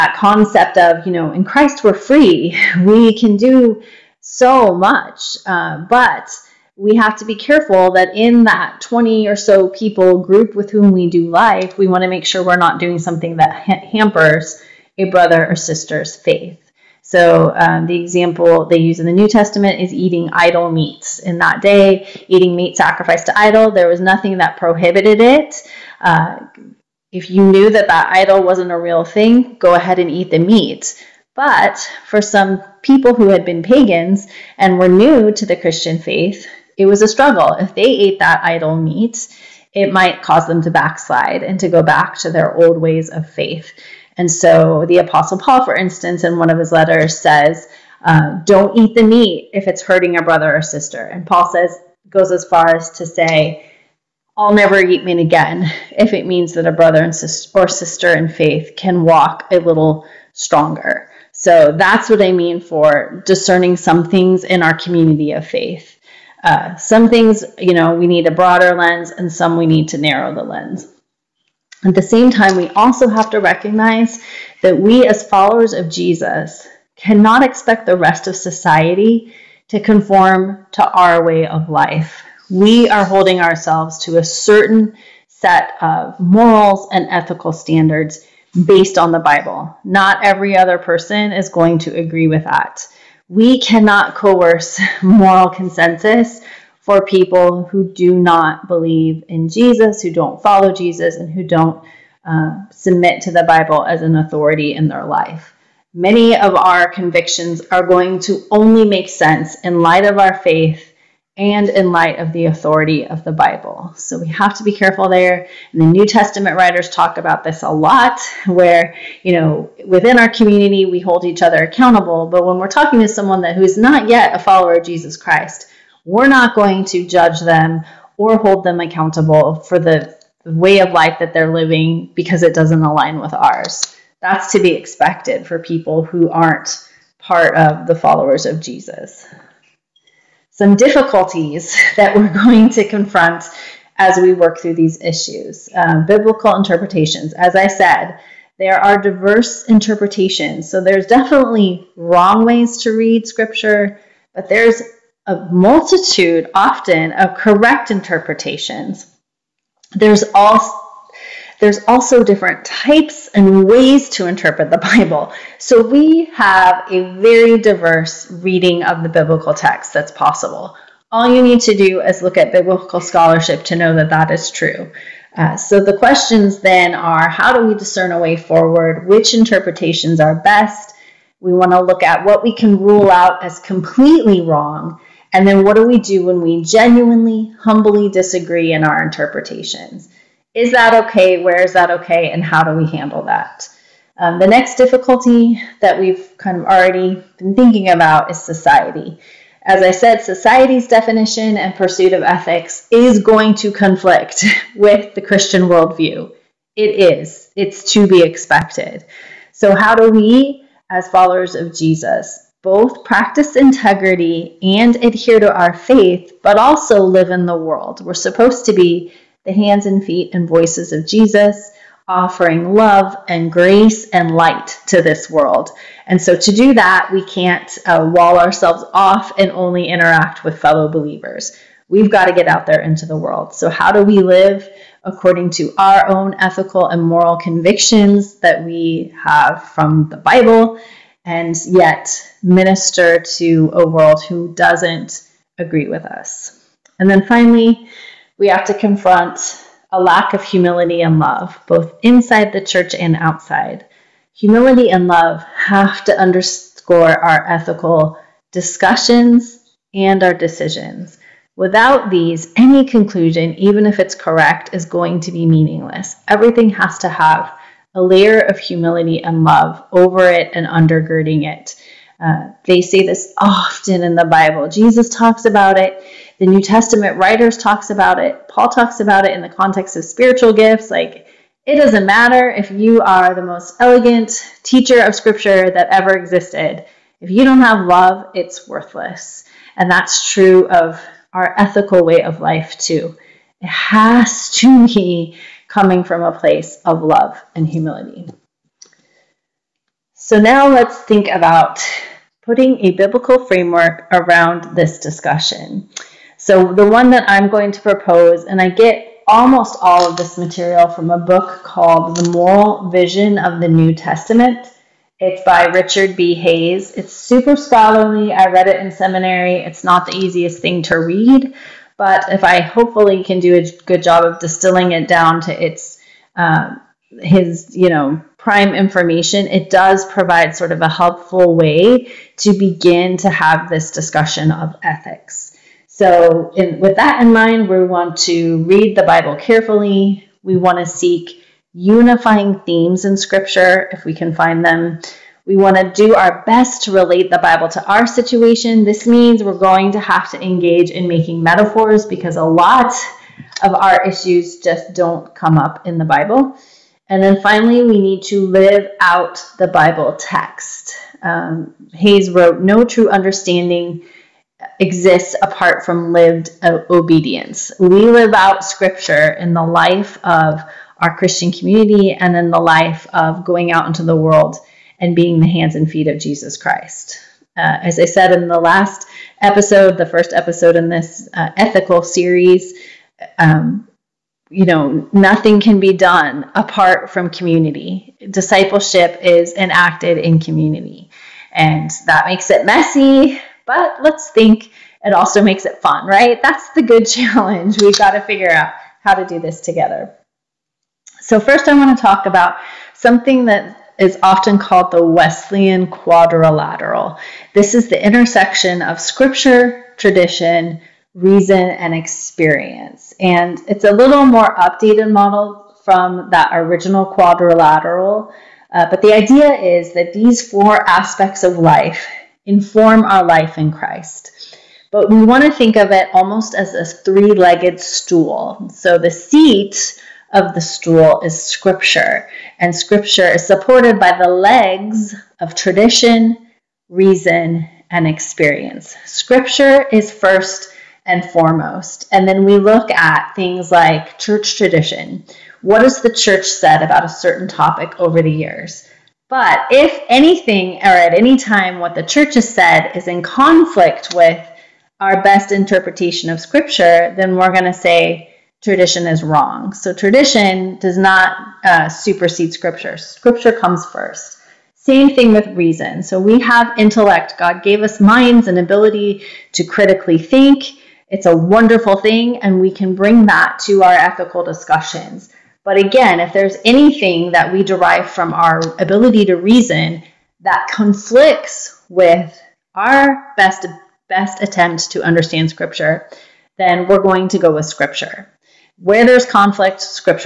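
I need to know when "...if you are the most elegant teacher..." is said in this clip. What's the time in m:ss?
4:42.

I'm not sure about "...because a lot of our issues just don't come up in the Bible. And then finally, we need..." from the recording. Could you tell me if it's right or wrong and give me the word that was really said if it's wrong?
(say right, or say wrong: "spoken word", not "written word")
right.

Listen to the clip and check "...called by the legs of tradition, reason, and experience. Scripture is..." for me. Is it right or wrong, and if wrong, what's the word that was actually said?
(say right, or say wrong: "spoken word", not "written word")
wrong: "supported", not "called".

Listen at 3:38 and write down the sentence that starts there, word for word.
We're supposed to be the hands and feet and voices of Jesus, offering love and grace and light to this world.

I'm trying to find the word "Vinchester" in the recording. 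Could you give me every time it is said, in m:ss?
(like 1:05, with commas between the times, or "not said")
not said.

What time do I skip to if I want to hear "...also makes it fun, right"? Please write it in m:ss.
6:35.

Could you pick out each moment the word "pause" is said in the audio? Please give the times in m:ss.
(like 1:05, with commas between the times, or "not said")
not said.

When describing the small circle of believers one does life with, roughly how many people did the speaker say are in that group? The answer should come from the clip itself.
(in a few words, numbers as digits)
20.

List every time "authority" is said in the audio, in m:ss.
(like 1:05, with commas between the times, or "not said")
1:44, 1:52.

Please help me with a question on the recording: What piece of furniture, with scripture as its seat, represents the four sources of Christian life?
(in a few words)
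Three legged stool.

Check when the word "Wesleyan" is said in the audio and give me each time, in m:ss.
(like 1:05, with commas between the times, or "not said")
6:45.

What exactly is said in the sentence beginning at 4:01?
and yet minister to a world who doesn't agree with us.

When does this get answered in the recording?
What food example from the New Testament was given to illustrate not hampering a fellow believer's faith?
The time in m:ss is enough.
0:20.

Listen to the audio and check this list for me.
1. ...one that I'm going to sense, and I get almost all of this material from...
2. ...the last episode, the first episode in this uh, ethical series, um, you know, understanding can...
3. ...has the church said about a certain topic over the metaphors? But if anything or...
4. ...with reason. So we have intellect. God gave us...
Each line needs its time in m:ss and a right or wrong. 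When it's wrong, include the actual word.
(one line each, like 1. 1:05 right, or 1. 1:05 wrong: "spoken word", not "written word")
1. 5:06 wrong: "propose", not "sense"
2. 6:18 wrong: "nothing", not "understanding"
3. 7:25 wrong: "years", not "metaphors"
4. 7:45 right.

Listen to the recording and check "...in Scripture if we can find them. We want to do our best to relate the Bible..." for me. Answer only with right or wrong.
right.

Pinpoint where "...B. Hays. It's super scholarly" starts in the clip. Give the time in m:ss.
5:16.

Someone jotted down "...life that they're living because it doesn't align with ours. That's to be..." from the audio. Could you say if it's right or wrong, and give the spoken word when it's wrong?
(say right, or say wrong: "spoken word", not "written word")
right.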